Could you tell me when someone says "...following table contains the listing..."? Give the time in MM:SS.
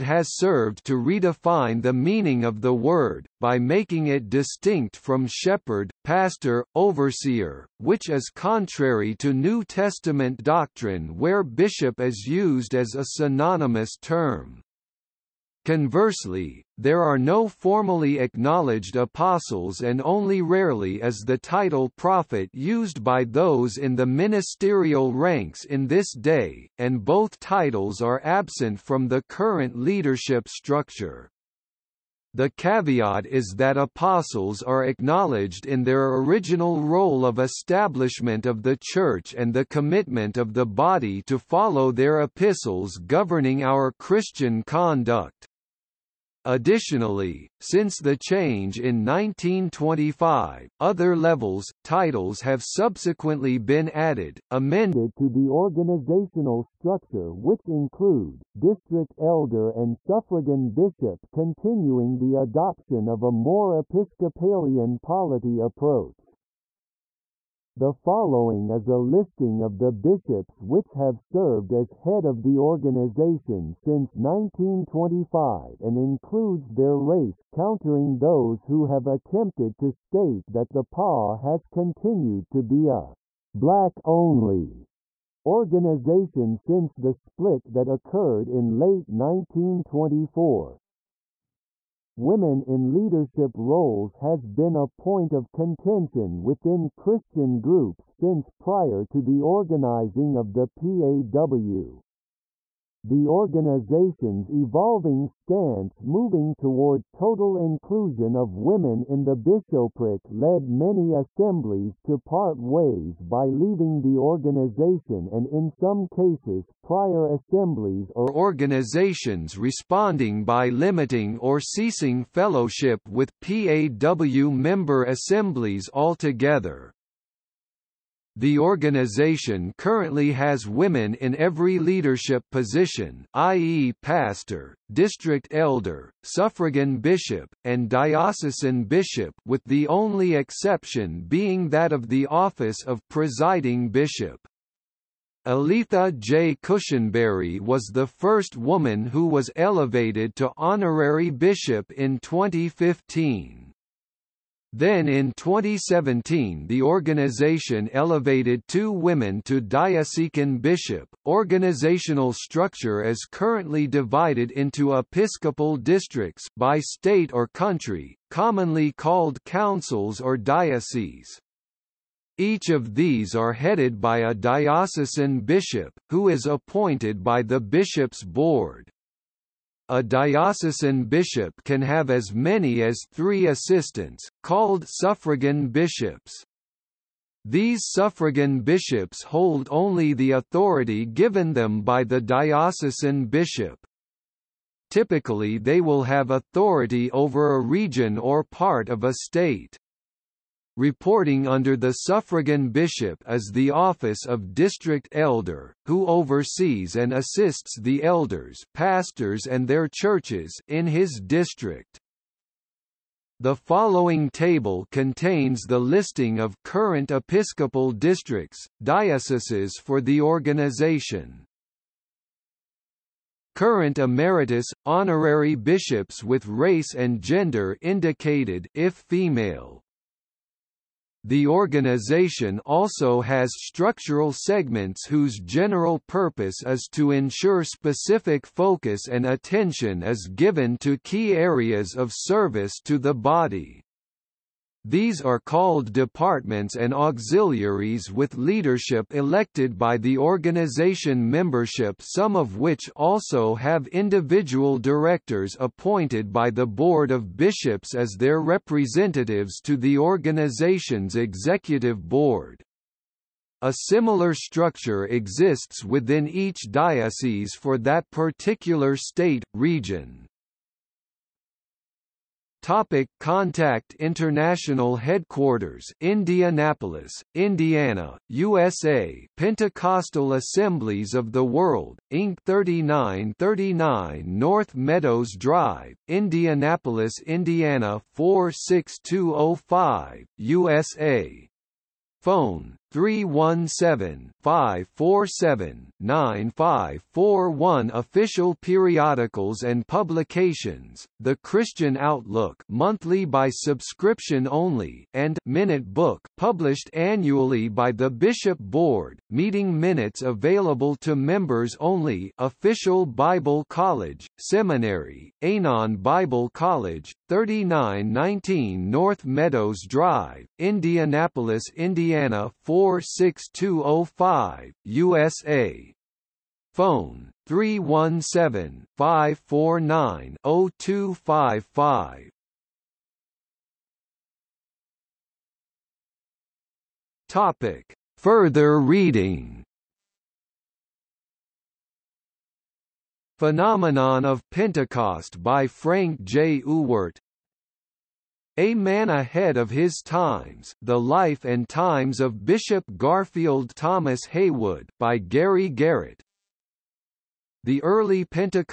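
03:33.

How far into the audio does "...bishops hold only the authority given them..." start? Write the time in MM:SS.
03:08.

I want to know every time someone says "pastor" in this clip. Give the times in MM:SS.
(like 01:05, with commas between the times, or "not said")
00:06, 02:14, 03:28.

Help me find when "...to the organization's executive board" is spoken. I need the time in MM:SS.
04:19.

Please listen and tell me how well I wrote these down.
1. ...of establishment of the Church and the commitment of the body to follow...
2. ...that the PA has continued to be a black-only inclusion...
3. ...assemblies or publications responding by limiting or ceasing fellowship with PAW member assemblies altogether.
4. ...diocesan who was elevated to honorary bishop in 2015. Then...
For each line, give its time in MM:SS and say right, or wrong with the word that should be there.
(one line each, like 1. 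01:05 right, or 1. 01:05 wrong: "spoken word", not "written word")
1. 00:37 right
2. 01:20 wrong: "organization", not "inclusion"
3. 01:57 wrong: "organizations", not "publications"
4. 02:28 wrong: "woman", not "diocesan".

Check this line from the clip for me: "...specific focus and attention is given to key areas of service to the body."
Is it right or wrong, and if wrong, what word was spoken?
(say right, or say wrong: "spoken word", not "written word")
right.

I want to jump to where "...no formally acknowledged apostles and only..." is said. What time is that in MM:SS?
00:17.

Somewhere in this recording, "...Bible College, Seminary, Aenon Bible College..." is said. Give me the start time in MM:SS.
05:13.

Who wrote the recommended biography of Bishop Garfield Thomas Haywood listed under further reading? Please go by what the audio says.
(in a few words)
Gary Garrett.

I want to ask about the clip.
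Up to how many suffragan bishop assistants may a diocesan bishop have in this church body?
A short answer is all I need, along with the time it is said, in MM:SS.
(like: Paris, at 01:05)
3, at 03:03.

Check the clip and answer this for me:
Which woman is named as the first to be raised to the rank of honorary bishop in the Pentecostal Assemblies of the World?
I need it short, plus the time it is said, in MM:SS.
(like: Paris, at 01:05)
Aletha J. Cushenberry, at 02:25.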